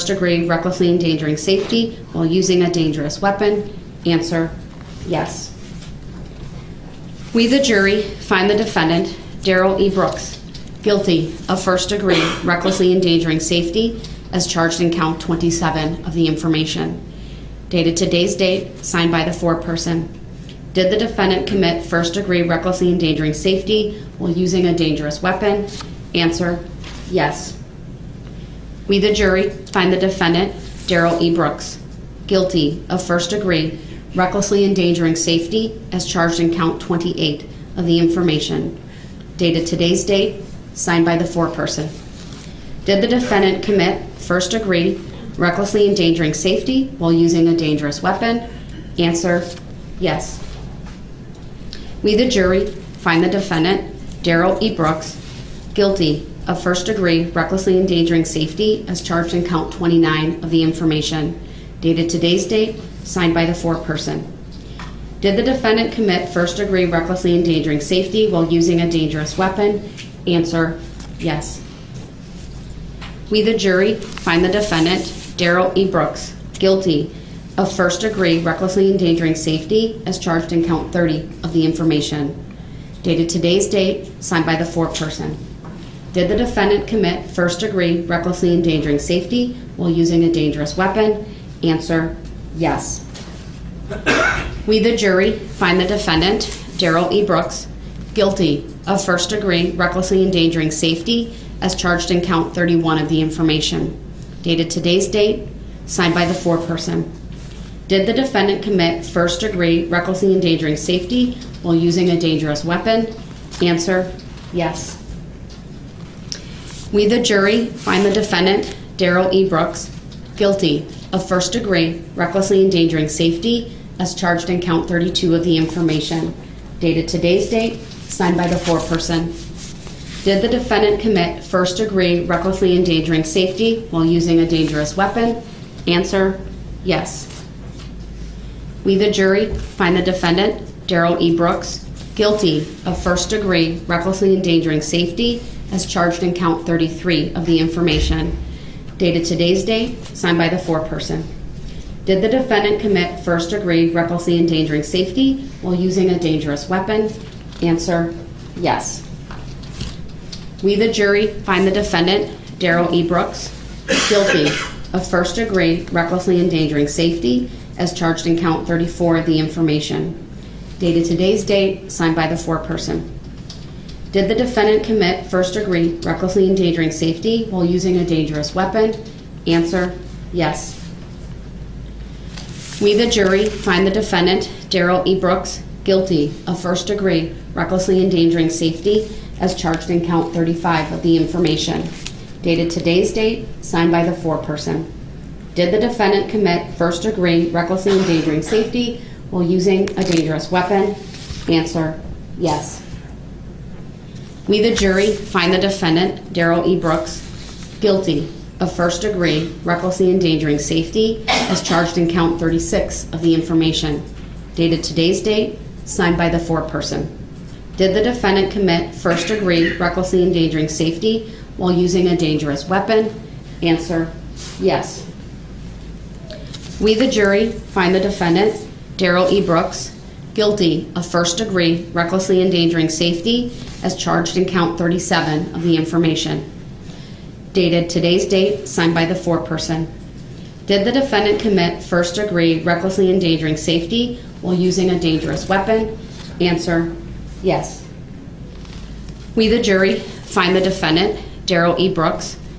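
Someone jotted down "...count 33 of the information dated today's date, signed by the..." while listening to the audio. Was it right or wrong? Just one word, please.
right.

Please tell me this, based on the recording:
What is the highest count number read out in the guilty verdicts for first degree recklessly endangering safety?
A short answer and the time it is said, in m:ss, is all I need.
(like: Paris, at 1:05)
37, at 3:54.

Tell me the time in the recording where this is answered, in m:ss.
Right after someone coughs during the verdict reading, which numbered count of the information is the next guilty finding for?
1:42.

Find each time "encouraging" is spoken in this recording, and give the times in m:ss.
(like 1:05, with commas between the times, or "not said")
not said.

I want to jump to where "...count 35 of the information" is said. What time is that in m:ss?
3:10.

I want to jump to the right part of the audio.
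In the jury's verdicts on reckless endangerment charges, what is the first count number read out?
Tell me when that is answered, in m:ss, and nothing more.
0:14.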